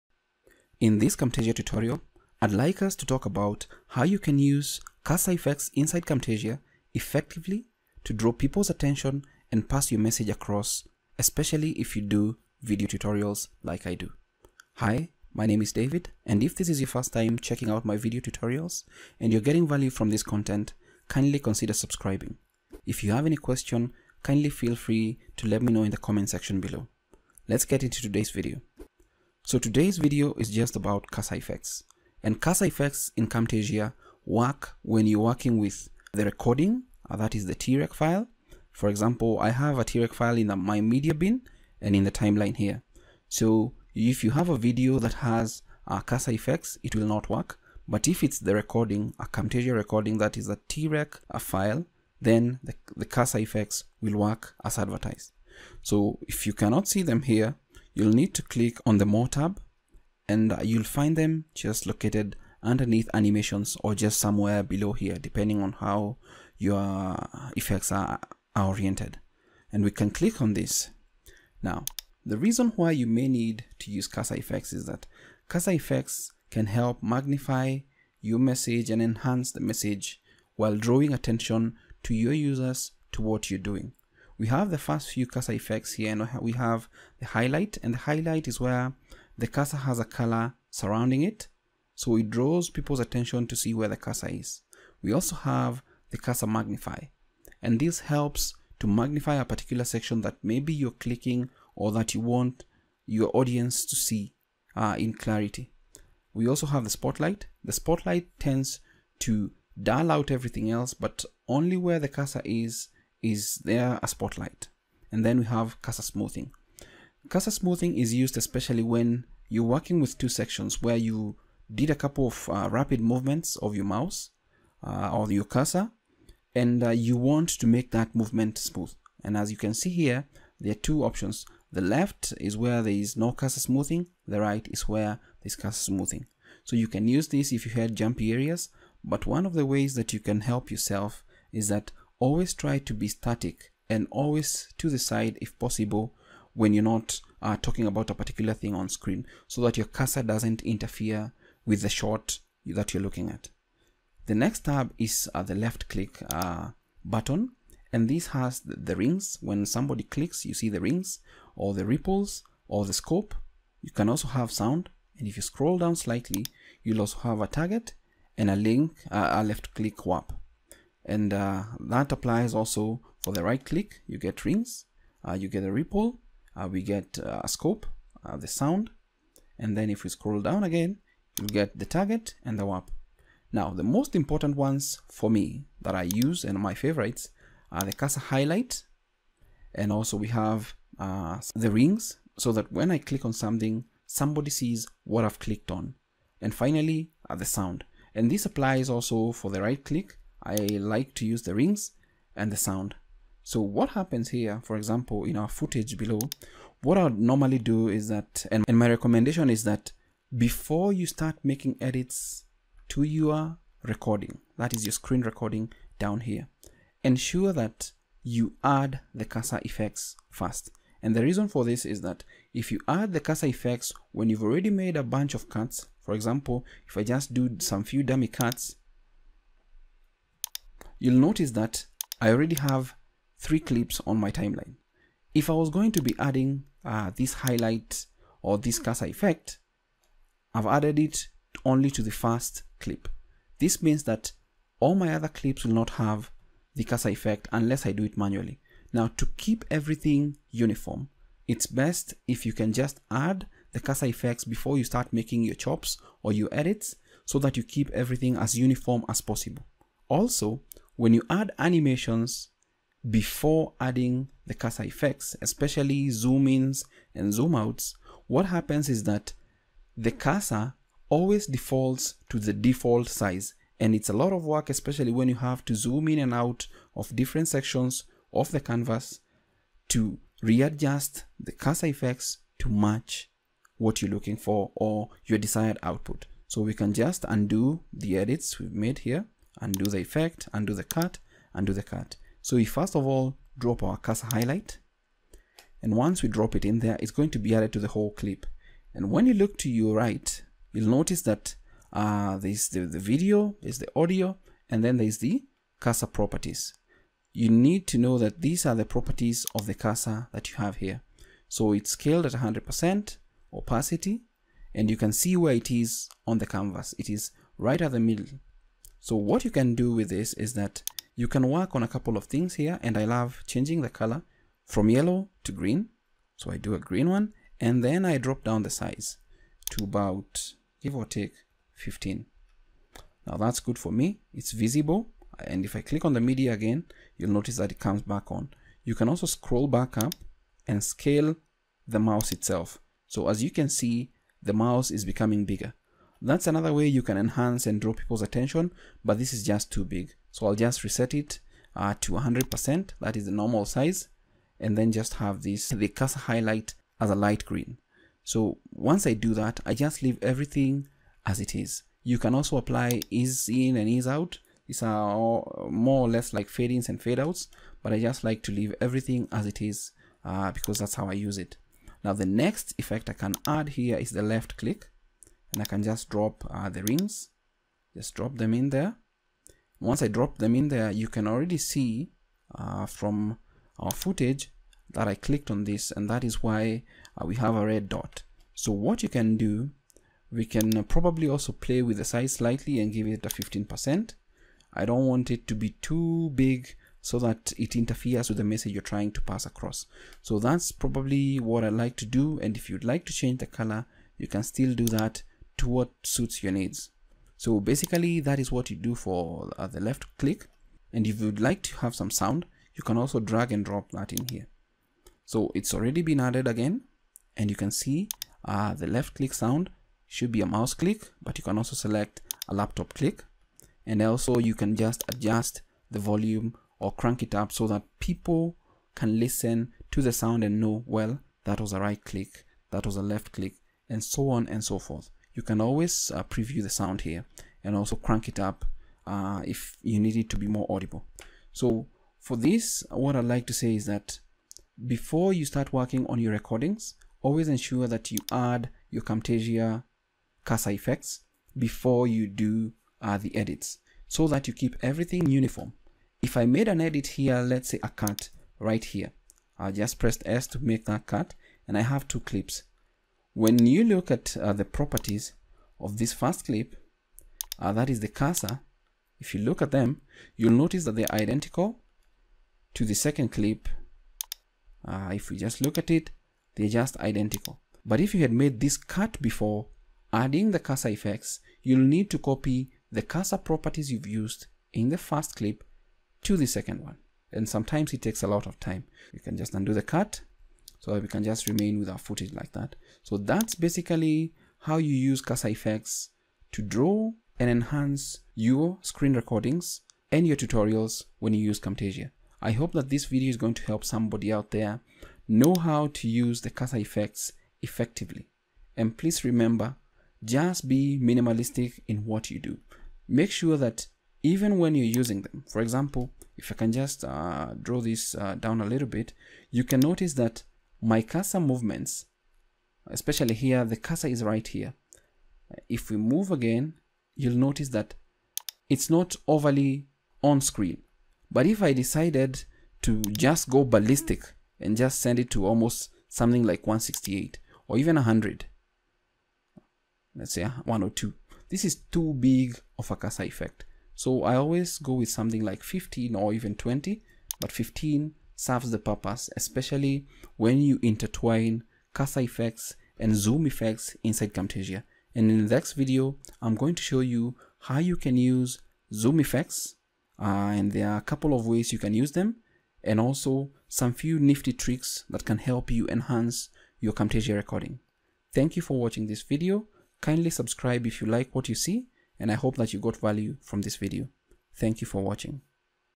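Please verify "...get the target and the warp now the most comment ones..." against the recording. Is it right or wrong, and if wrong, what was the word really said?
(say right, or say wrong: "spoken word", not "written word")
wrong: "important", not "comment".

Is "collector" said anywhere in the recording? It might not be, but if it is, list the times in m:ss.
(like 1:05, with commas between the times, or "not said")
not said.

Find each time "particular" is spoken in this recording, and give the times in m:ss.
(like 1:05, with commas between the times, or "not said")
1:39, 2:28.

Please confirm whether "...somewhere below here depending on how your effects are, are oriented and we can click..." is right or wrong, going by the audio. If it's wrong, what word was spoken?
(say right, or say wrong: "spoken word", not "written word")
right.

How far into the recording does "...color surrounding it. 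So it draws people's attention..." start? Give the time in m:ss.
1:30.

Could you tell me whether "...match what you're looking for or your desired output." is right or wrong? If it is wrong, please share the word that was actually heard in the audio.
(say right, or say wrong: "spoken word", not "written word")
right.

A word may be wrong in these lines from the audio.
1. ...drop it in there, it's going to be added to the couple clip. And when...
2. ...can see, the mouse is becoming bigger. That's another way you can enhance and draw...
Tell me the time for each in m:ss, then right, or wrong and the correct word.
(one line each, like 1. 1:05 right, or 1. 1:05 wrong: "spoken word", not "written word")
1. 4:56 wrong: "whole", not "couple"
2. 5:43 right.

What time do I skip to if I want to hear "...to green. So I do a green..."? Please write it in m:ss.
5:25.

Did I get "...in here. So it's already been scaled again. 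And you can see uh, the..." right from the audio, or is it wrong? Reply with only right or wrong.
wrong.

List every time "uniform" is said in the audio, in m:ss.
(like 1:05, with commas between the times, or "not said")
4:10, 4:18, 7:35.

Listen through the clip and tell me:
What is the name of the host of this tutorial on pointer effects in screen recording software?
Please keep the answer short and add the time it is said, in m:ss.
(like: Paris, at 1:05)
David, at 0:15.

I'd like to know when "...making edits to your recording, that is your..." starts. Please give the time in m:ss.
3:31.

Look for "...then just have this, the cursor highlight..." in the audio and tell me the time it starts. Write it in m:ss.
5:54.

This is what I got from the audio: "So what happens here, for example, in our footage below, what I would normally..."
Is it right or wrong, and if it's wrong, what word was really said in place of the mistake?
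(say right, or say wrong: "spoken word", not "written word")
right.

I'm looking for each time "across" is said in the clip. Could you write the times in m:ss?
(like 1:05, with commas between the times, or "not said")
0:10, 6:39.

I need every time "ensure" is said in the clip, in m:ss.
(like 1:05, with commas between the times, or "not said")
3:37, 7:27.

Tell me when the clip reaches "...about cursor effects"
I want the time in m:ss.
0:30.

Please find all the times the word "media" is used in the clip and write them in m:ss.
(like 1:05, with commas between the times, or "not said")
0:40, 5:36.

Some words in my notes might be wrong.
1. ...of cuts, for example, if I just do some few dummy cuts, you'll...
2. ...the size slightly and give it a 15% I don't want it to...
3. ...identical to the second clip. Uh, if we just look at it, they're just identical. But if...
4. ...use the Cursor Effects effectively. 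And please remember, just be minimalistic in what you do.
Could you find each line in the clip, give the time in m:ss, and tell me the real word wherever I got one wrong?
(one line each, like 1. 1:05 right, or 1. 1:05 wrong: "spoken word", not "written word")
1. 3:45 right
2. 6:31 right
3. 7:51 right
4. 8:26 right.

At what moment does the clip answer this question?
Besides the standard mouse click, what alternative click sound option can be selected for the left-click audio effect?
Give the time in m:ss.
7:02.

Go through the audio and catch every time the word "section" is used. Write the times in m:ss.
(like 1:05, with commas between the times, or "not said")
0:26, 1:39, 2:00, 4:37.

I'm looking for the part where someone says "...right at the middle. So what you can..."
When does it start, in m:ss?
5:17.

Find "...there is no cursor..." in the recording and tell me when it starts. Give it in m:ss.
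2:12.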